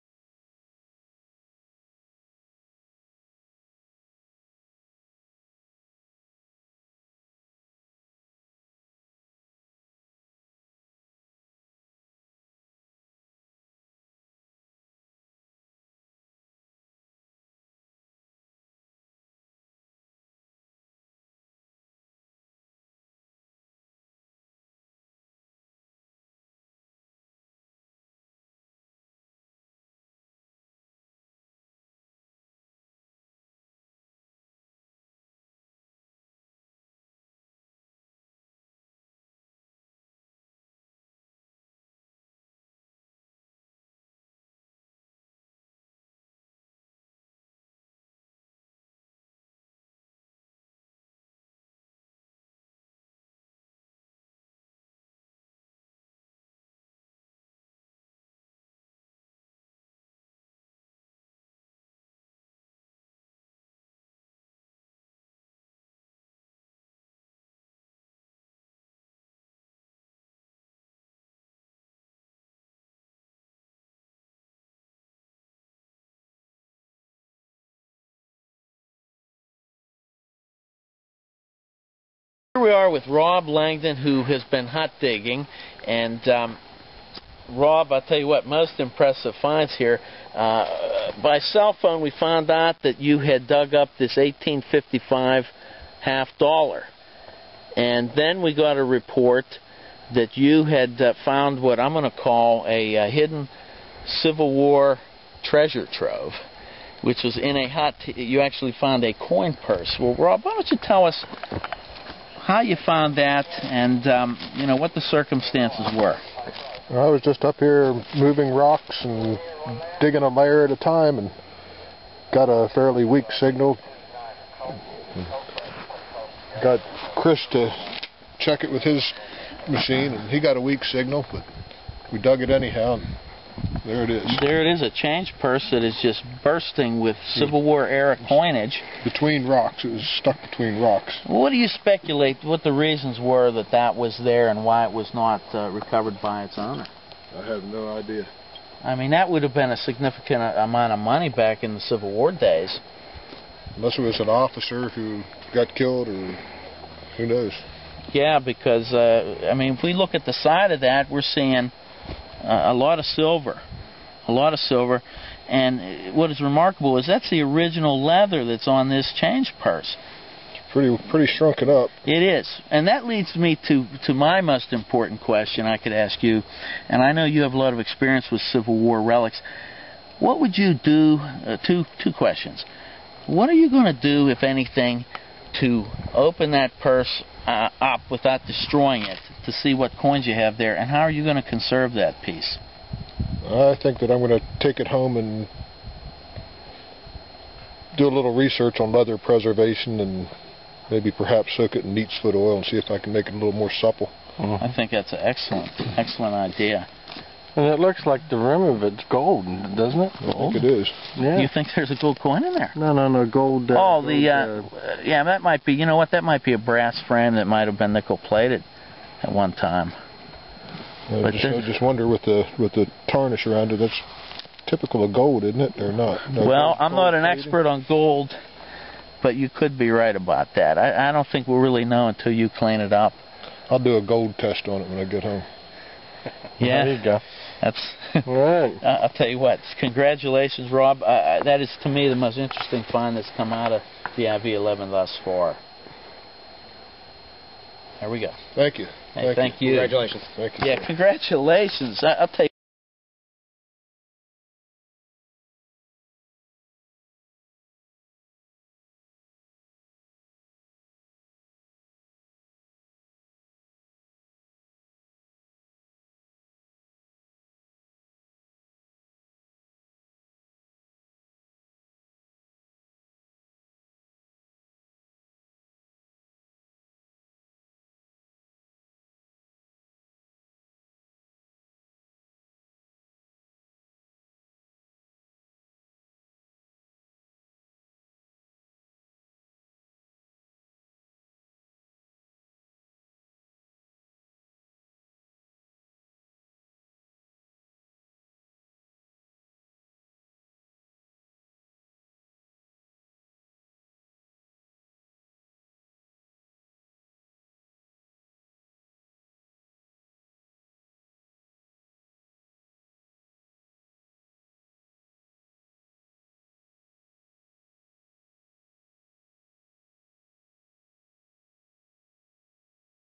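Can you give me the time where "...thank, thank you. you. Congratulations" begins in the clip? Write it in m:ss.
4:09.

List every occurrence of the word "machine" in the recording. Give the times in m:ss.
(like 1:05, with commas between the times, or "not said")
2:09.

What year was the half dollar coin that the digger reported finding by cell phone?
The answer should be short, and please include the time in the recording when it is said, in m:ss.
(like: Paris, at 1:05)
1855, at 1:34.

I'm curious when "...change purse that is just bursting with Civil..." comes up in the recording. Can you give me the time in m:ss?
2:14.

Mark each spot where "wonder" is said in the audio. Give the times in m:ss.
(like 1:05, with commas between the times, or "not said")
3:41.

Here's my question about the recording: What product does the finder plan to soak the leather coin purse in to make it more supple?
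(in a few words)
Neat's foot oil.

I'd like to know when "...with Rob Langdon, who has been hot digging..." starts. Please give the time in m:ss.
1:22.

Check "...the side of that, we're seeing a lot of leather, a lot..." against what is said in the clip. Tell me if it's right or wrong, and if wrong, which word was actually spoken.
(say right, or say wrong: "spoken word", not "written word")
wrong: "silver", not "leather".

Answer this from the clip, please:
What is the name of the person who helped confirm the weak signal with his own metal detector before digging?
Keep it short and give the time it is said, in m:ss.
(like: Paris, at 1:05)
Chris, at 2:07.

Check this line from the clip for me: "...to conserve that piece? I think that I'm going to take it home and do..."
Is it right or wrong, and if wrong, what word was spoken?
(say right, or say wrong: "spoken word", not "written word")
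right.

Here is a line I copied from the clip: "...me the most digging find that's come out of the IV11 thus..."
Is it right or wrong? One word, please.
wrong.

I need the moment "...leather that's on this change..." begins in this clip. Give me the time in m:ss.
2:48.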